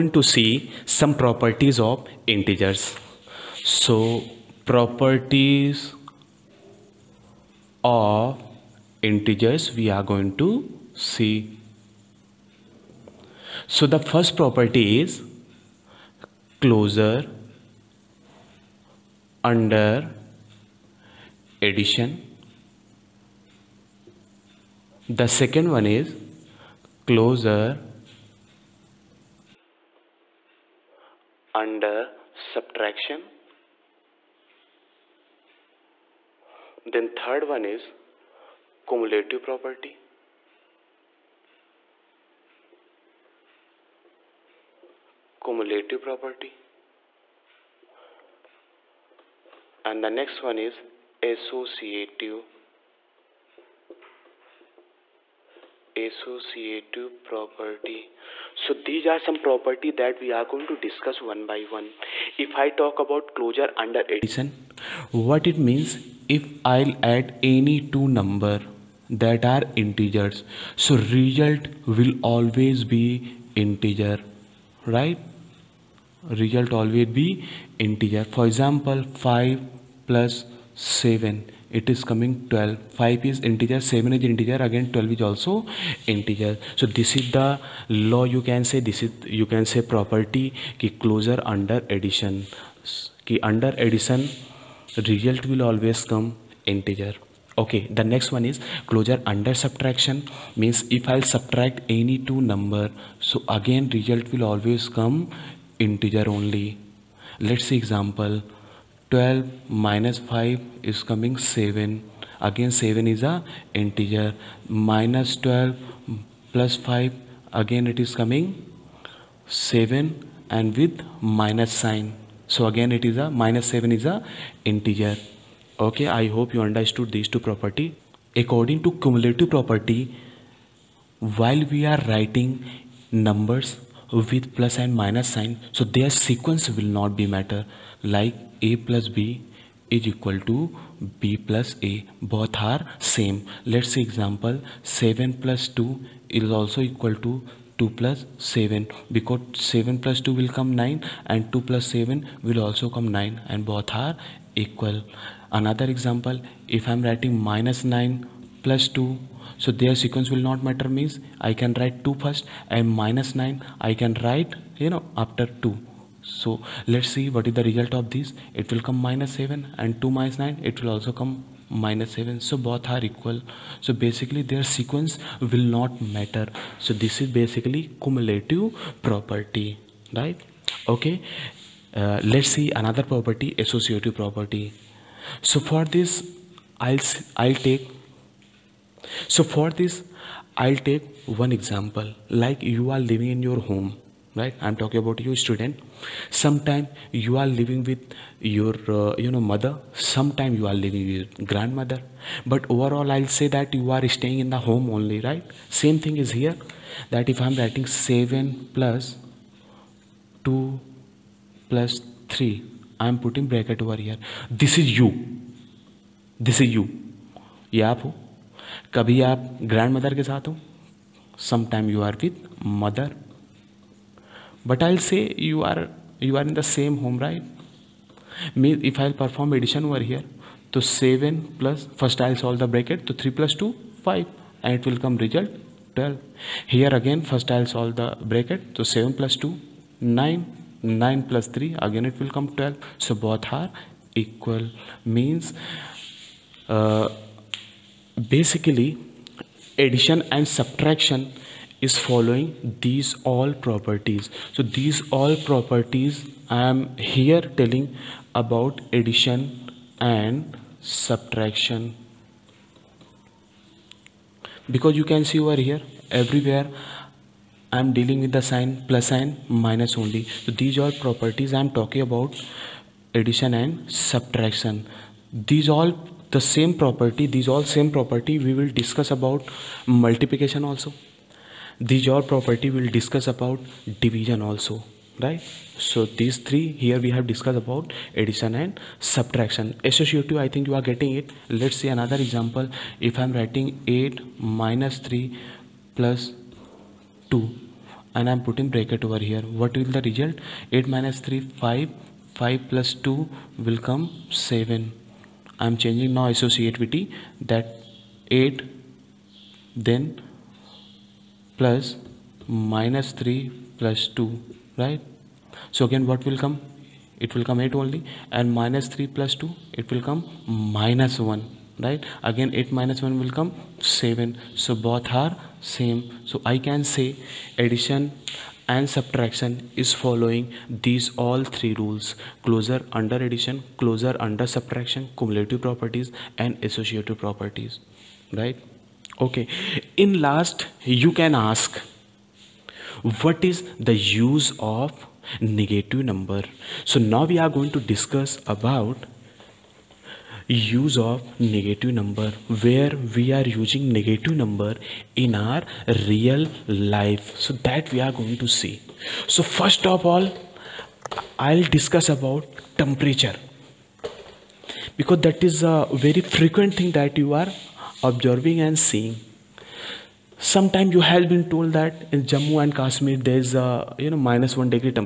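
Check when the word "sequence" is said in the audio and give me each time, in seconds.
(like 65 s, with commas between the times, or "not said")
136 s, 160 s, 174 s.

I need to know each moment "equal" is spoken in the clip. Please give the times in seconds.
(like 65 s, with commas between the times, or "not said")
140 s, 146 s, 154 s, 173 s, 244 s.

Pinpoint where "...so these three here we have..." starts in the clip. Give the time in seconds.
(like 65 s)
285 s.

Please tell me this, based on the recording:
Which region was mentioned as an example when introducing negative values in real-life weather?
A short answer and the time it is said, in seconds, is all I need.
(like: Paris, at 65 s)
Jammu and Kashmir, at 372 s.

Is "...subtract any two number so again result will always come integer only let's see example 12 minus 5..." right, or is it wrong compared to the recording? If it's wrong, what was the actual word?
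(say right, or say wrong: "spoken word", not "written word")
right.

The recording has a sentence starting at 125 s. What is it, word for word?
Okay, I hope you understood these two property.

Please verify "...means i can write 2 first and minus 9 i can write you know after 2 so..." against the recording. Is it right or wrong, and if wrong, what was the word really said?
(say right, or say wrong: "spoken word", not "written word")
right.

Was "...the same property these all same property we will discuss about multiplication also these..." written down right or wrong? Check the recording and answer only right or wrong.
right.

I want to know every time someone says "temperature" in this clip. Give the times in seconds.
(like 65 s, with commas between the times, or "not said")
362 s.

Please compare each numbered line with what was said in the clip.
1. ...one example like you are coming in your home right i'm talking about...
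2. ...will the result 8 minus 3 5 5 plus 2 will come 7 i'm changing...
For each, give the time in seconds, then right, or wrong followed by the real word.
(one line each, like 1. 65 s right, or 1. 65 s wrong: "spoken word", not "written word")
1. 191 s wrong: "living", not "coming"
2. 299 s right.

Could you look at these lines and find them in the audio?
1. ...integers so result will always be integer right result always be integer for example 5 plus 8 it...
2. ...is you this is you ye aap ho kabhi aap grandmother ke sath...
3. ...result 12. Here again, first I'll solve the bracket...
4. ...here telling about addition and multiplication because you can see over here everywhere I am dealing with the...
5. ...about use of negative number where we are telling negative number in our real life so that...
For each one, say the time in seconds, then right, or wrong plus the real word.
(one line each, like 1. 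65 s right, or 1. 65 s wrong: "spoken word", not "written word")
1. 69 s wrong: "7", not "8"
2. 214 s right
3. 235 s right
4. 257 s wrong: "subtraction", not "multiplication"
5. 348 s wrong: "using", not "telling".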